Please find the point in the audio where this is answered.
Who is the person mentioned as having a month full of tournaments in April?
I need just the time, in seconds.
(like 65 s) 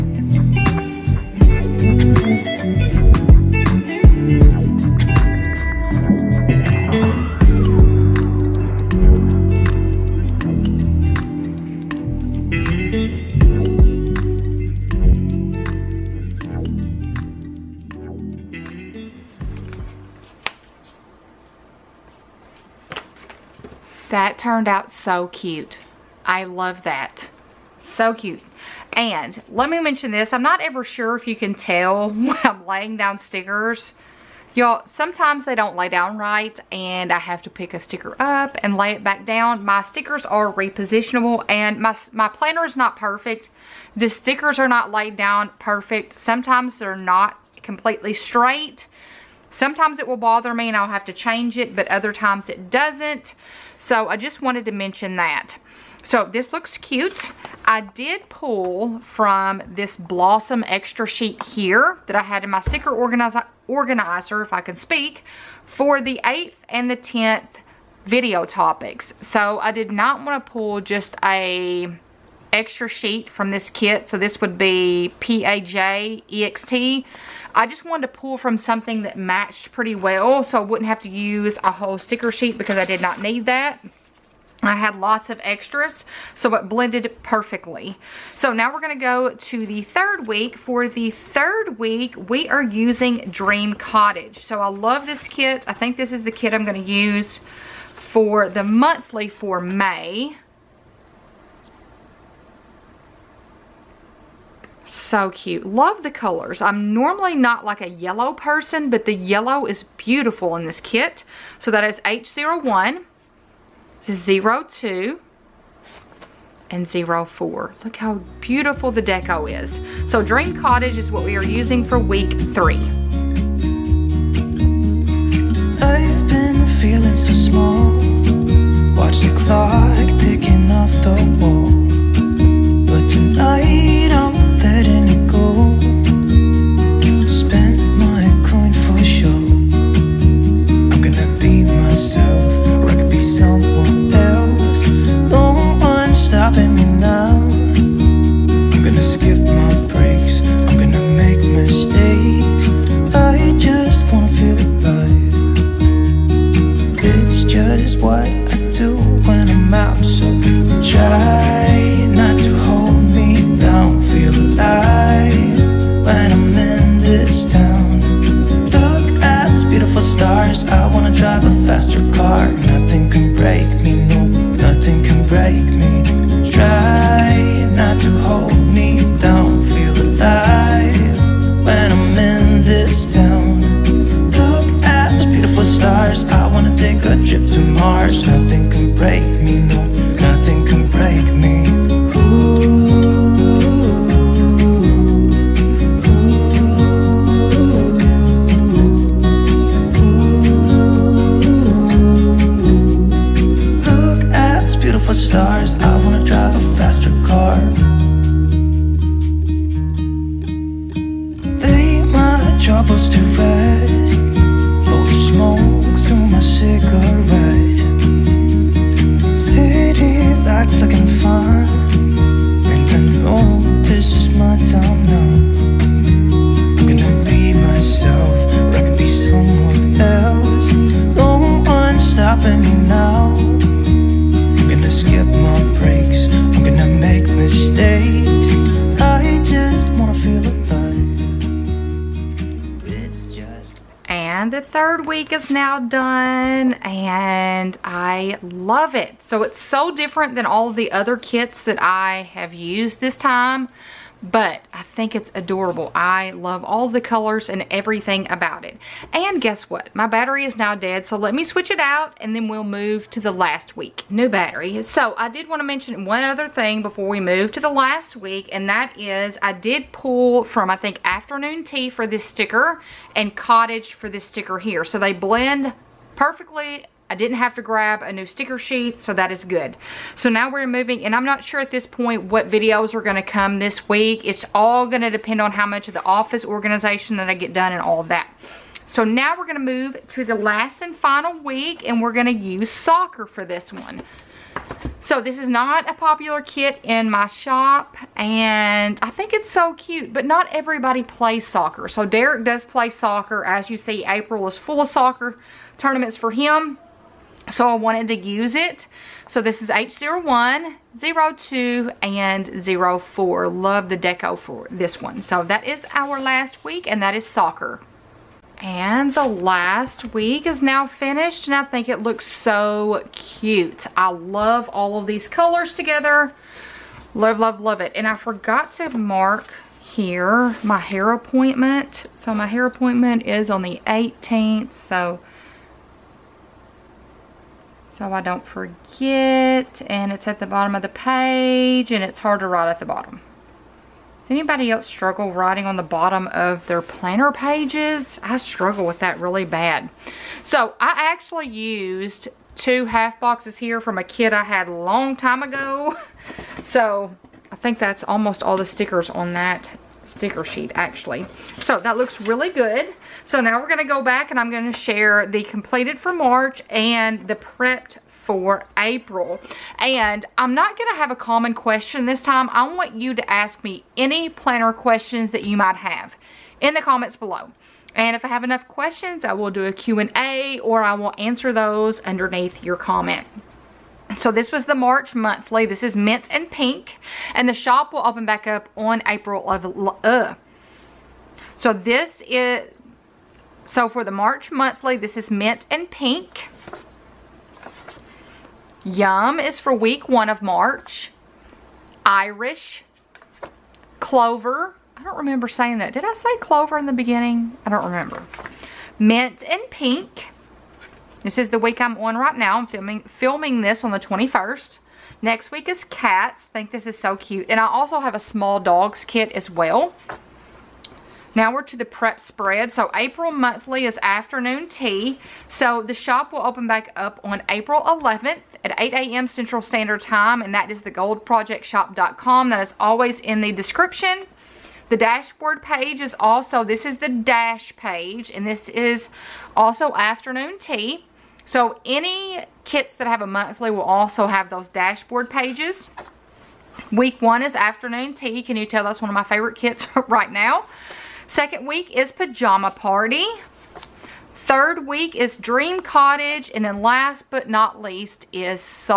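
301 s.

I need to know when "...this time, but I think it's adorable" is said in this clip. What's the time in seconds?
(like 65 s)
253 s.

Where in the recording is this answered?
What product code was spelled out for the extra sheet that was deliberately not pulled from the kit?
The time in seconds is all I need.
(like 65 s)
75 s.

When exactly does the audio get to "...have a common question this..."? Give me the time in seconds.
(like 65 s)
370 s.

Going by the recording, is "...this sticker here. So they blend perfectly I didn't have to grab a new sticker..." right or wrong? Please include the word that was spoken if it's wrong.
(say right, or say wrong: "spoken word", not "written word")
right.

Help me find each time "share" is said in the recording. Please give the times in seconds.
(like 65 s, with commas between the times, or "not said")
364 s.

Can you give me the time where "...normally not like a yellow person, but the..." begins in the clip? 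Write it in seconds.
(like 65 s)
106 s.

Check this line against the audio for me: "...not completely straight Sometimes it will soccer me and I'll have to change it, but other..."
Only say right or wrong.
wrong.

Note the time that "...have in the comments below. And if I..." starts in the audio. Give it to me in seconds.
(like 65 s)
375 s.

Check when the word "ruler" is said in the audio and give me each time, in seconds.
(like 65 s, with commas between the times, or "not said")
not said.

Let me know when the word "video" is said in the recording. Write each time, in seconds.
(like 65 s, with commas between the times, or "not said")
68 s, 282 s.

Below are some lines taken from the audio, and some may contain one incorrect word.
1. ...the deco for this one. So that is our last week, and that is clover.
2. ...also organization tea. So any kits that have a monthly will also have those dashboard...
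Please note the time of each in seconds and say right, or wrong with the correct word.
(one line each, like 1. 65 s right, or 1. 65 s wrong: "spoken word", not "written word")
1. 313 s wrong: "soccer", not "clover"
2. 439 s wrong: "afternoon", not "organization".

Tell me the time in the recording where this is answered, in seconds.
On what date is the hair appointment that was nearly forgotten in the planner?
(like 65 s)
332 s.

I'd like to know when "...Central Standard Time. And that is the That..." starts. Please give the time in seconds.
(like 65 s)
429 s.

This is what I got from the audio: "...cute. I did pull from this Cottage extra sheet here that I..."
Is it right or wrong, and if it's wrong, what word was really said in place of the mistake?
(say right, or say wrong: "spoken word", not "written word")
wrong: "Blossom", not "Cottage".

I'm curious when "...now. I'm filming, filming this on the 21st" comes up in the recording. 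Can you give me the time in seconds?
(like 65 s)
412 s.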